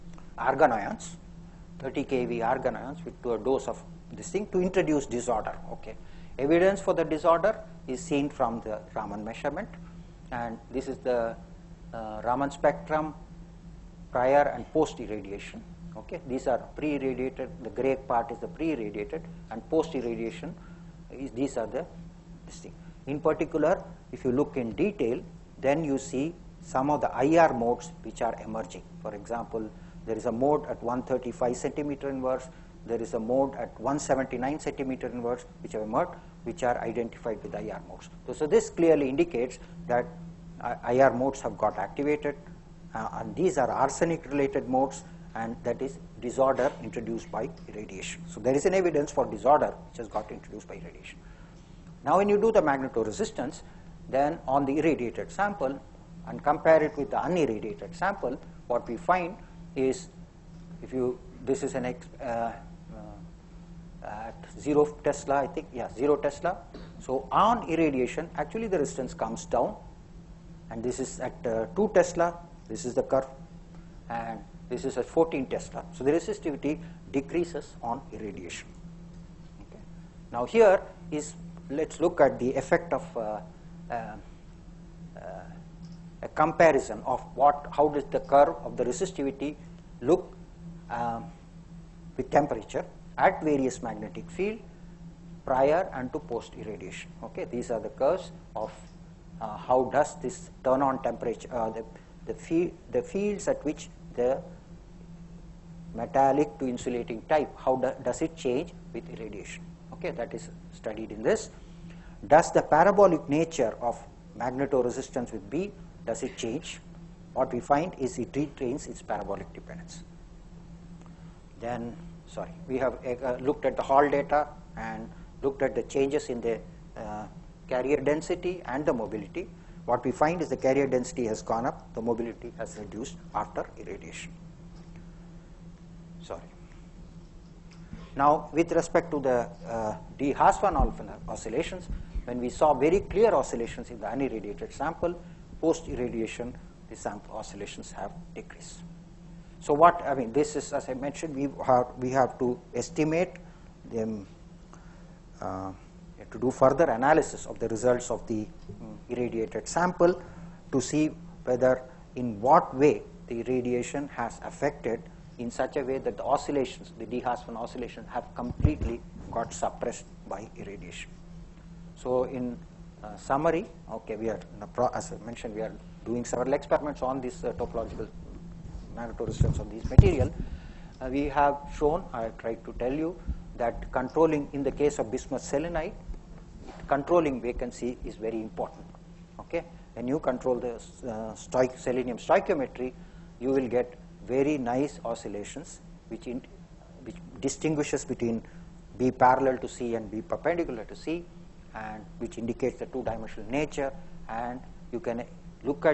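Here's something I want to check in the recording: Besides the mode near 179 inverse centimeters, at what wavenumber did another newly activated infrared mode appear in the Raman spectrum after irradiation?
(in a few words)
135 cm⁻¹.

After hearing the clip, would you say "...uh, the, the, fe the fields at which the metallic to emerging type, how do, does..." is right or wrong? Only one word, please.
wrong.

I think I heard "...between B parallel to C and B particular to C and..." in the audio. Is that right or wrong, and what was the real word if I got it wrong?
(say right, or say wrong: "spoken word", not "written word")
wrong: "perpendicular", not "particular".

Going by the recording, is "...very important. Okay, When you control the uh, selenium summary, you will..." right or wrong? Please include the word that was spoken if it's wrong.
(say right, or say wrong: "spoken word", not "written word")
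wrong: "stoichiometry", not "summary".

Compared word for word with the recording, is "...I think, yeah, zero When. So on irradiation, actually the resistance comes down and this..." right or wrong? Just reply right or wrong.
wrong.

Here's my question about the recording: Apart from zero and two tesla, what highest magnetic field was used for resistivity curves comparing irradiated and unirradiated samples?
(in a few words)
14 Tesla.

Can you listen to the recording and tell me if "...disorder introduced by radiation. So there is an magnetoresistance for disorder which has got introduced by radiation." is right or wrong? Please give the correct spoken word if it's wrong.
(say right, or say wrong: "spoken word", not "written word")
wrong: "evidence", not "magnetoresistance".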